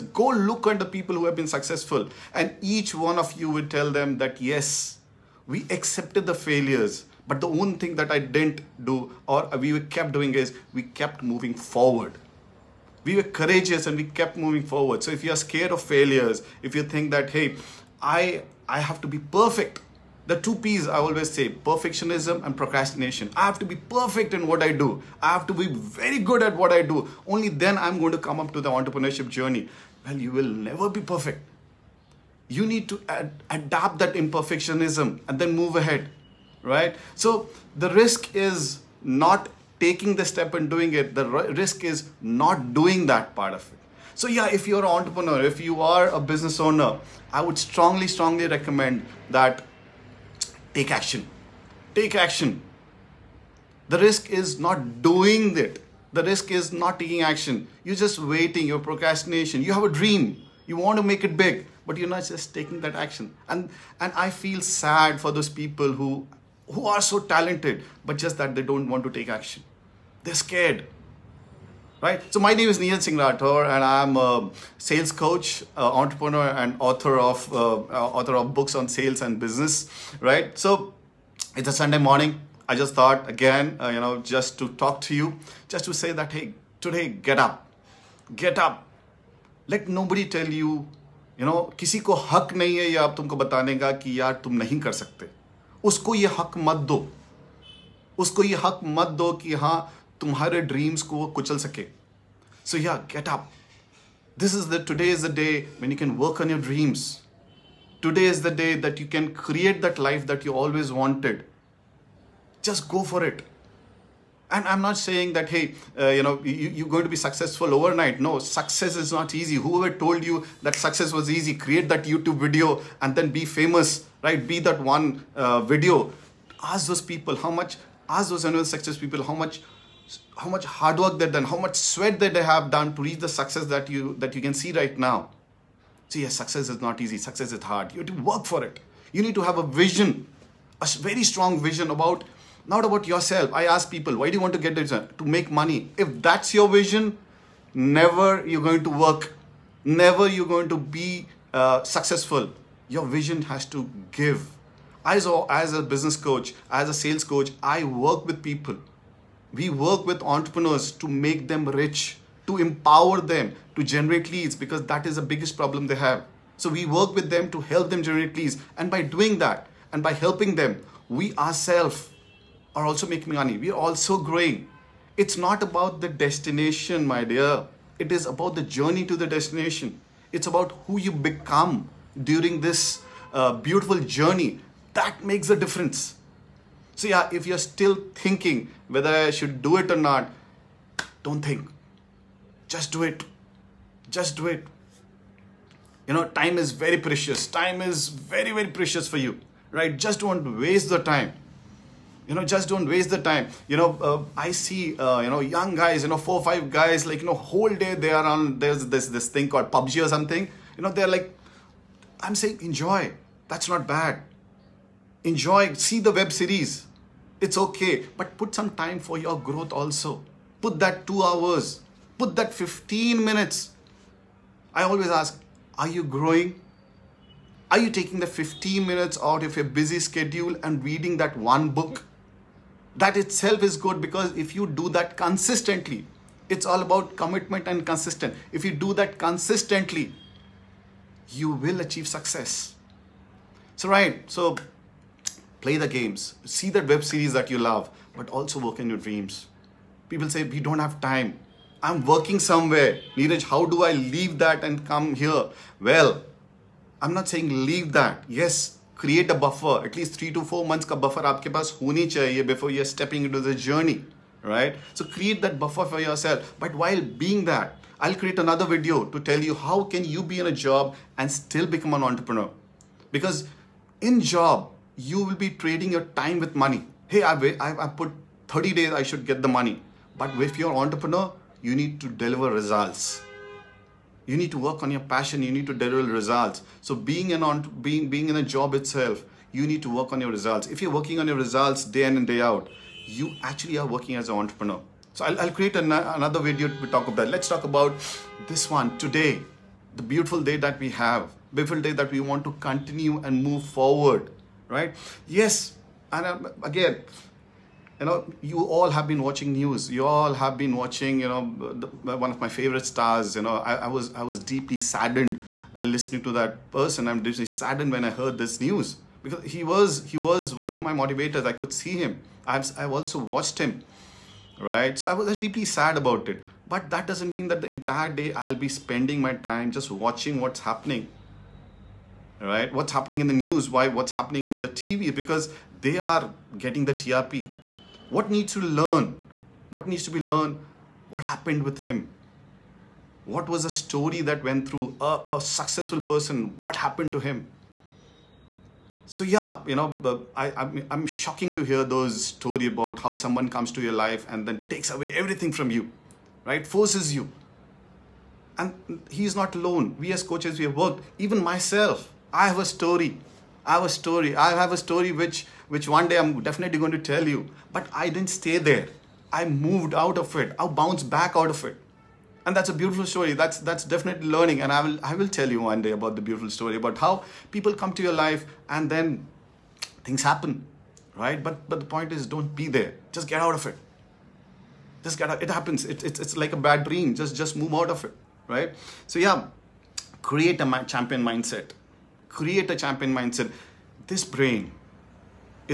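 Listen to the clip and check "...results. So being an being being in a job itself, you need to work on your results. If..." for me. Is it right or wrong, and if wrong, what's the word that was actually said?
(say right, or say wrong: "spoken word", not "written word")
right.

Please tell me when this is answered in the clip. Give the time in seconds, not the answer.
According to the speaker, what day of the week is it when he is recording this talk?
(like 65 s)
81 s.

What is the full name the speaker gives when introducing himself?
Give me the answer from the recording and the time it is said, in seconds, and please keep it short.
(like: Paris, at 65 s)
Neeraj Singh Rathore, at 72 s.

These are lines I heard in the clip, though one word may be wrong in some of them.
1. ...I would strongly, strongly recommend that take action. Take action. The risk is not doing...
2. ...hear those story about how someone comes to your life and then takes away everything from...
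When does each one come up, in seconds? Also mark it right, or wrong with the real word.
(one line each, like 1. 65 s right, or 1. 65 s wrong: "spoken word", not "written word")
1. 47 s right
2. 351 s right.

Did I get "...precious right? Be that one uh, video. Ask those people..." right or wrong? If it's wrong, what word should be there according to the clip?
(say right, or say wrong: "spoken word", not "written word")
wrong: "famous", not "precious".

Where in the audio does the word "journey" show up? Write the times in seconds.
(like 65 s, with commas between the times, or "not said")
29 s, 178 s, 183 s, 263 s.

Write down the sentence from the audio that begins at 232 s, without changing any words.
That itself is good because if you do that consistently, it's all about commitment and consistent.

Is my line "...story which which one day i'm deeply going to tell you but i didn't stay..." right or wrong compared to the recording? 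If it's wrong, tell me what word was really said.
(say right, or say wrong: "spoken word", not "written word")
wrong: "definitely", not "deeply".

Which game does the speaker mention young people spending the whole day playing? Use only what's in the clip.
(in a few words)
PUBG.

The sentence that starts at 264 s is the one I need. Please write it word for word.
So create that buffer for yourself.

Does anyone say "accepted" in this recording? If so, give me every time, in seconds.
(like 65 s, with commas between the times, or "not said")
5 s.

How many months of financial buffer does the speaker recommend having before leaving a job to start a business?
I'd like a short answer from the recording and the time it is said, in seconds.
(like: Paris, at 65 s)
3 to 4 months, at 260 s.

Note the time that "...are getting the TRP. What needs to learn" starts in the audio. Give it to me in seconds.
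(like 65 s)
335 s.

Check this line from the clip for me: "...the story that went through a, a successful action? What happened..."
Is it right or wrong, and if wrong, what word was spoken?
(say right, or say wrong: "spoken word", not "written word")
wrong: "person", not "action".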